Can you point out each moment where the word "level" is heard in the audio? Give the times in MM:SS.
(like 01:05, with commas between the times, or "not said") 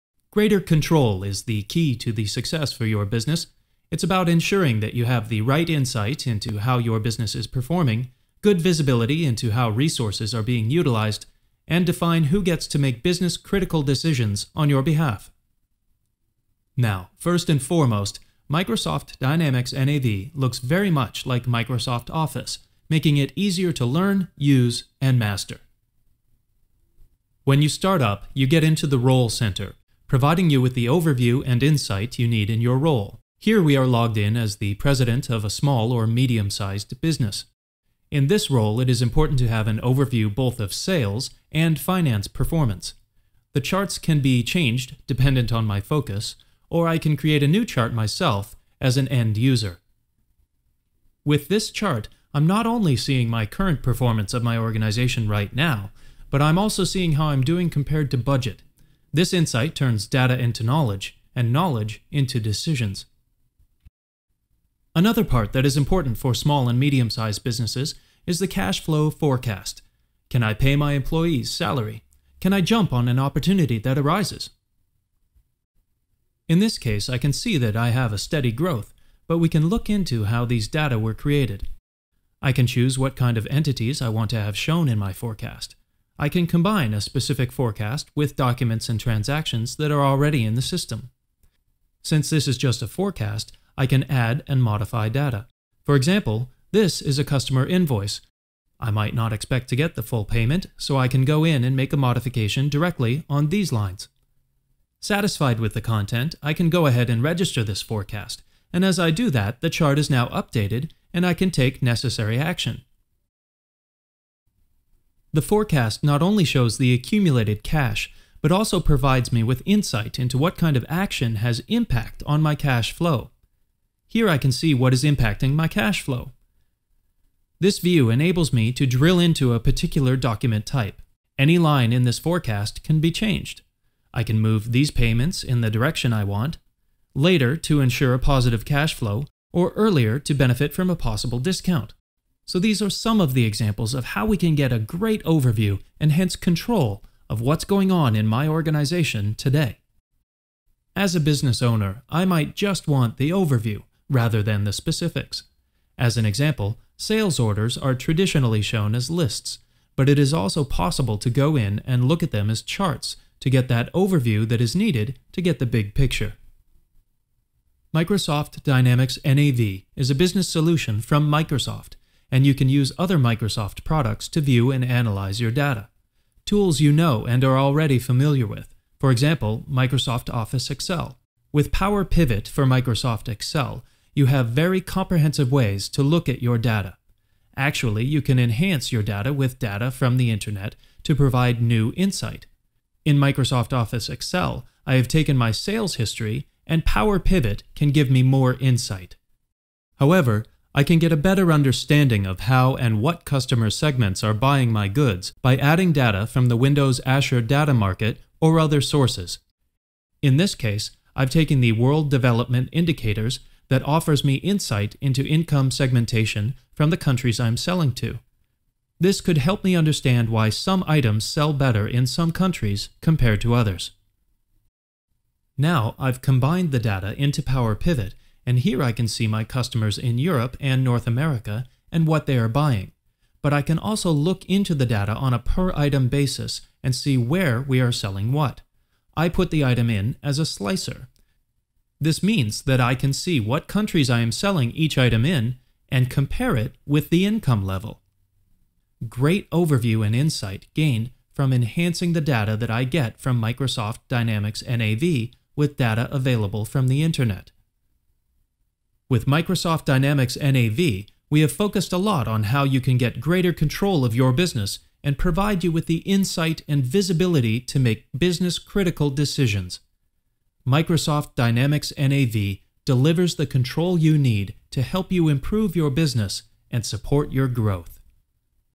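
04:07.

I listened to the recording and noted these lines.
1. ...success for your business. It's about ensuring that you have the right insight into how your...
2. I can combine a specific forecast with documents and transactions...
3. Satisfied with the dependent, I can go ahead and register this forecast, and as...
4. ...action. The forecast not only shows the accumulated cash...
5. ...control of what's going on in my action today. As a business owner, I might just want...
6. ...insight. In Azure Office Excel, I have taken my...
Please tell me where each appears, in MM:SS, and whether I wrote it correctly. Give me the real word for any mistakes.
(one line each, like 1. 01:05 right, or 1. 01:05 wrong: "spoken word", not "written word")
1. 00:02 right
2. 01:26 right
3. 01:44 wrong: "content", not "dependent"
4. 01:52 right
5. 02:26 wrong: "organization", not "action"
6. 03:11 wrong: "Microsoft", not "Azure".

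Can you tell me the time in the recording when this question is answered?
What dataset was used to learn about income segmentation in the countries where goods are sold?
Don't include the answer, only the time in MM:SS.
03:31.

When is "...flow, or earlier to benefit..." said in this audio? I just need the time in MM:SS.
02:18.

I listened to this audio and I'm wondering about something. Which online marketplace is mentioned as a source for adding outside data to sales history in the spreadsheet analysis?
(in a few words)
Windows Azure Data Market.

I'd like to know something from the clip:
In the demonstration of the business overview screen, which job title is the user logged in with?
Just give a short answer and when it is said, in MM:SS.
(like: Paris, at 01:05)
President, at 00:34.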